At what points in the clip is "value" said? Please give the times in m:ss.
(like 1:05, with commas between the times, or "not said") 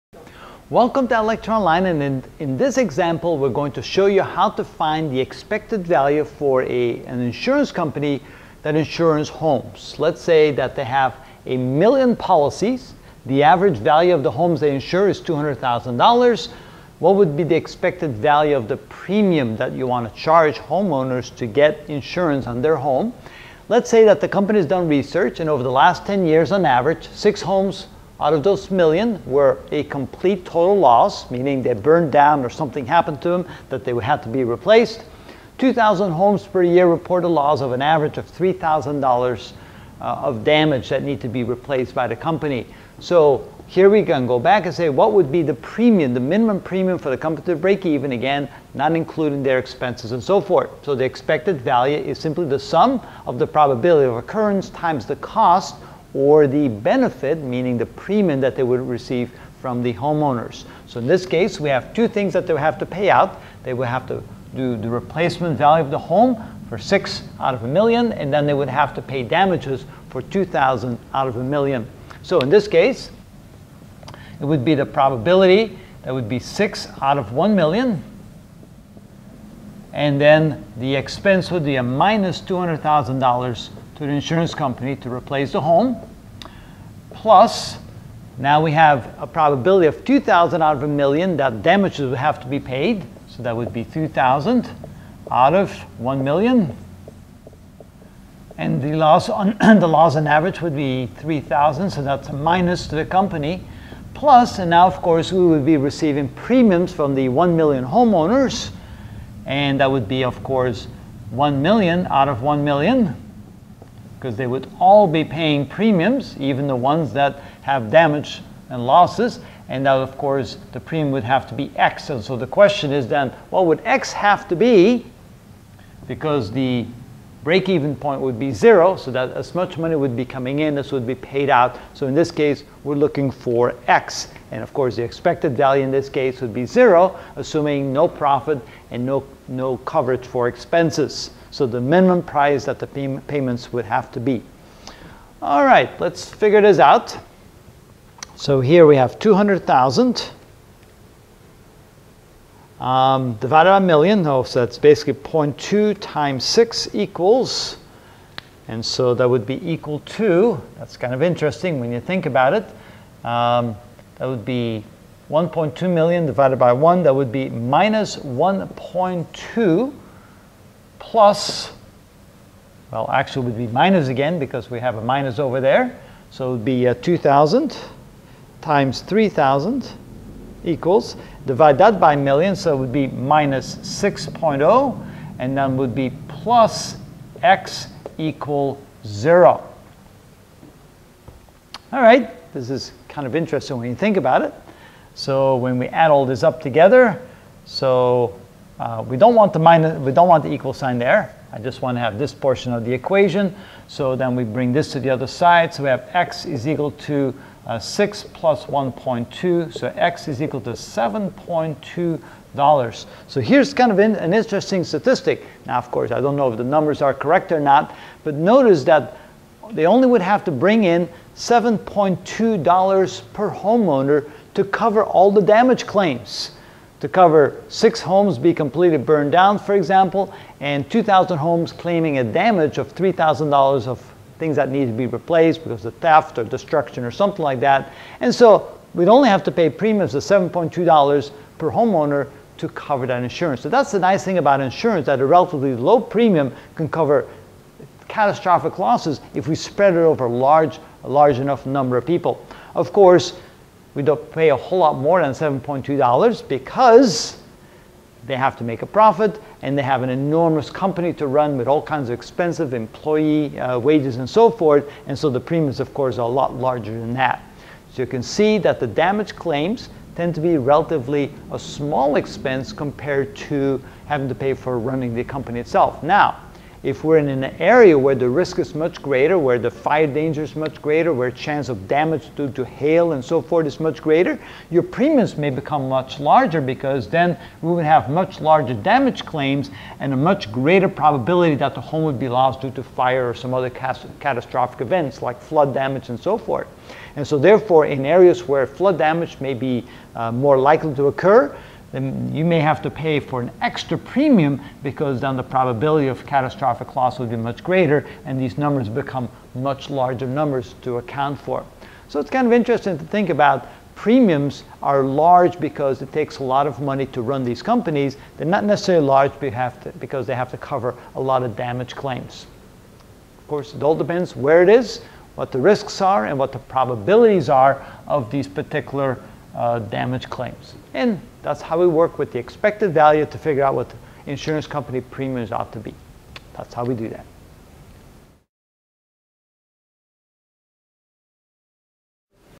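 0:05, 0:13, 0:18, 0:51, 1:05, 2:15, 5:32.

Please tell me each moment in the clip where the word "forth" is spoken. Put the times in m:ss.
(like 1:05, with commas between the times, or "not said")
0:50, 4:24, 4:43, 4:56.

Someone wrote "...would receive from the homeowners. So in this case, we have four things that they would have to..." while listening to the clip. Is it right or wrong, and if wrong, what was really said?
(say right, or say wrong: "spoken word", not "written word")
wrong: "two", not "four".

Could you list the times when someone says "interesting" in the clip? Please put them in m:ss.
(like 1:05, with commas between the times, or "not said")
2:41, 3:13, 3:34, 5:12.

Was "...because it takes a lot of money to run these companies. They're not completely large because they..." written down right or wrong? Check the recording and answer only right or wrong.
wrong.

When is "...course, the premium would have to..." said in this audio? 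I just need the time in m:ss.
2:00.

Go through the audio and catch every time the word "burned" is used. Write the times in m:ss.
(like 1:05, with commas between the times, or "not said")
0:31, 3:48.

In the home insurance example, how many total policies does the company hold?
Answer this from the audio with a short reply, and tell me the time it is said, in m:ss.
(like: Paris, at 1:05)
1 million, at 0:11.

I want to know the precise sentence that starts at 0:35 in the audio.
2,000 homes per year reported loss of an average of $3,000 uh, of damage that need to be replaced by the company.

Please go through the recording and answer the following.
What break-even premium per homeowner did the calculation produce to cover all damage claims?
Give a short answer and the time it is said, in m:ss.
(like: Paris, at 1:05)
$7.20, at 3:30.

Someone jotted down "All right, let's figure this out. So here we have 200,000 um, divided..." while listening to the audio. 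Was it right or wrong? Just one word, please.
right.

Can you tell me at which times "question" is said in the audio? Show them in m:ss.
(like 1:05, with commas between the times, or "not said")
2:02.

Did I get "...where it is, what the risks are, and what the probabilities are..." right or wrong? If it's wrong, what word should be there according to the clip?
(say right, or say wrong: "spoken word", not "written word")
right.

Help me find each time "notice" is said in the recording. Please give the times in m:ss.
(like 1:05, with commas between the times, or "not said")
3:38.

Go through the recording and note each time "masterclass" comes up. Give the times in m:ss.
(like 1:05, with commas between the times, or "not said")
not said.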